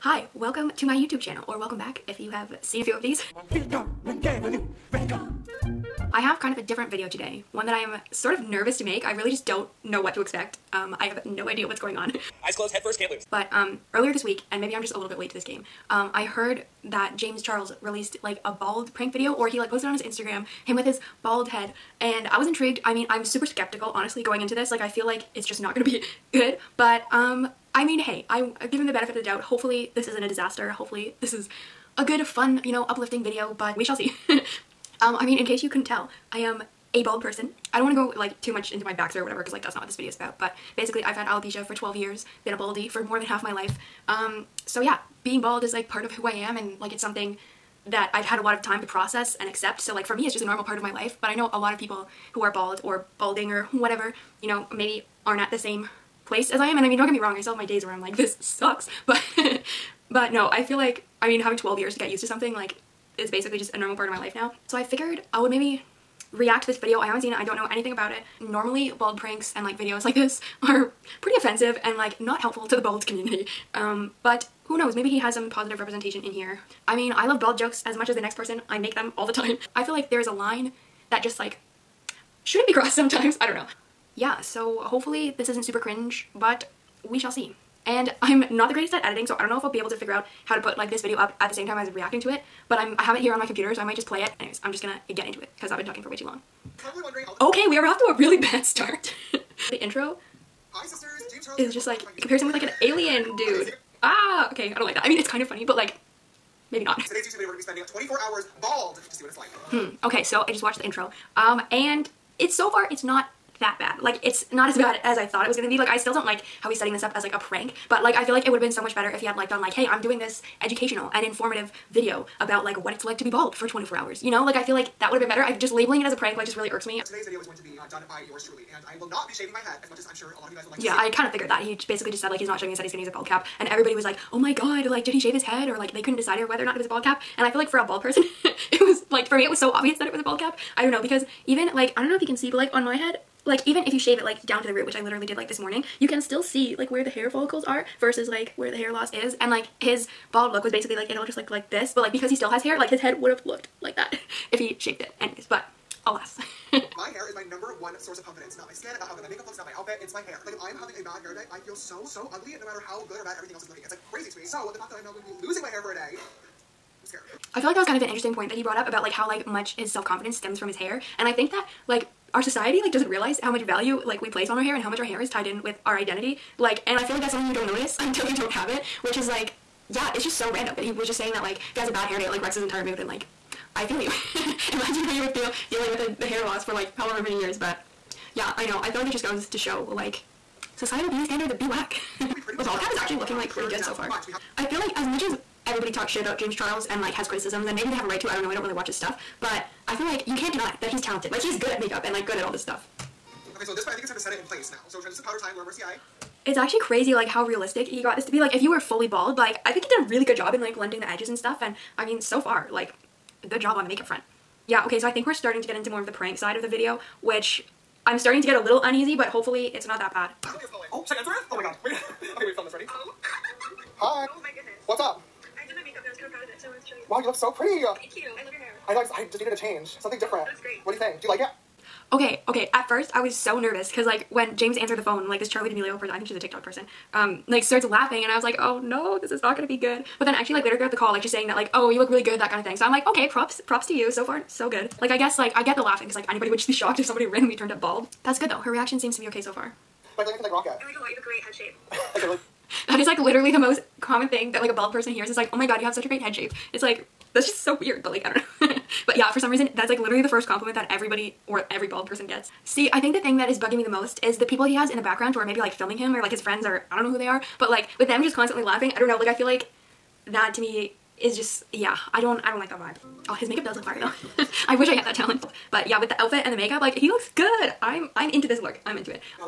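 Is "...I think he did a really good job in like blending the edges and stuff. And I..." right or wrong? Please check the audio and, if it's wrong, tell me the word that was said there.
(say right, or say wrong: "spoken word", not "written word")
right.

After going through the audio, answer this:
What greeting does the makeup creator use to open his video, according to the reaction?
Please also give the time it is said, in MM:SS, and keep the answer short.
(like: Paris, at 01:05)
Hi, sisters, at 01:40.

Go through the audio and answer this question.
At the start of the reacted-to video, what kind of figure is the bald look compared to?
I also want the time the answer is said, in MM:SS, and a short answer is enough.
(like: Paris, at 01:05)
An alien, at 01:42.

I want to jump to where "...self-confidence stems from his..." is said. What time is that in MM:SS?
02:49.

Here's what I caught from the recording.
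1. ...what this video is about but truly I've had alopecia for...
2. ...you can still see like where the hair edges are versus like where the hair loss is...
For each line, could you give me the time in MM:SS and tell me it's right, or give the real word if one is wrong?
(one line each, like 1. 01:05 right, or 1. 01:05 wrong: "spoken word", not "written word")
1. 00:39 wrong: "basically", not "truly"
2. 02:26 wrong: "follicles", not "edges".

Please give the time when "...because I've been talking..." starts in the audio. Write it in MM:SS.
01:35.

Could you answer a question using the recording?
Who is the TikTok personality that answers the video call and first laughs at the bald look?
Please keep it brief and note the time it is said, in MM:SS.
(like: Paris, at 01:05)
Charli D'Amelio, at 03:55.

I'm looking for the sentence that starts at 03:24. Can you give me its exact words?
So transition powder time, Laura Mercier.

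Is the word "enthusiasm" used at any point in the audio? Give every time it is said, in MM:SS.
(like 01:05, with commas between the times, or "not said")
not said.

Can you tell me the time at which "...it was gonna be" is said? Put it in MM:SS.
01:55.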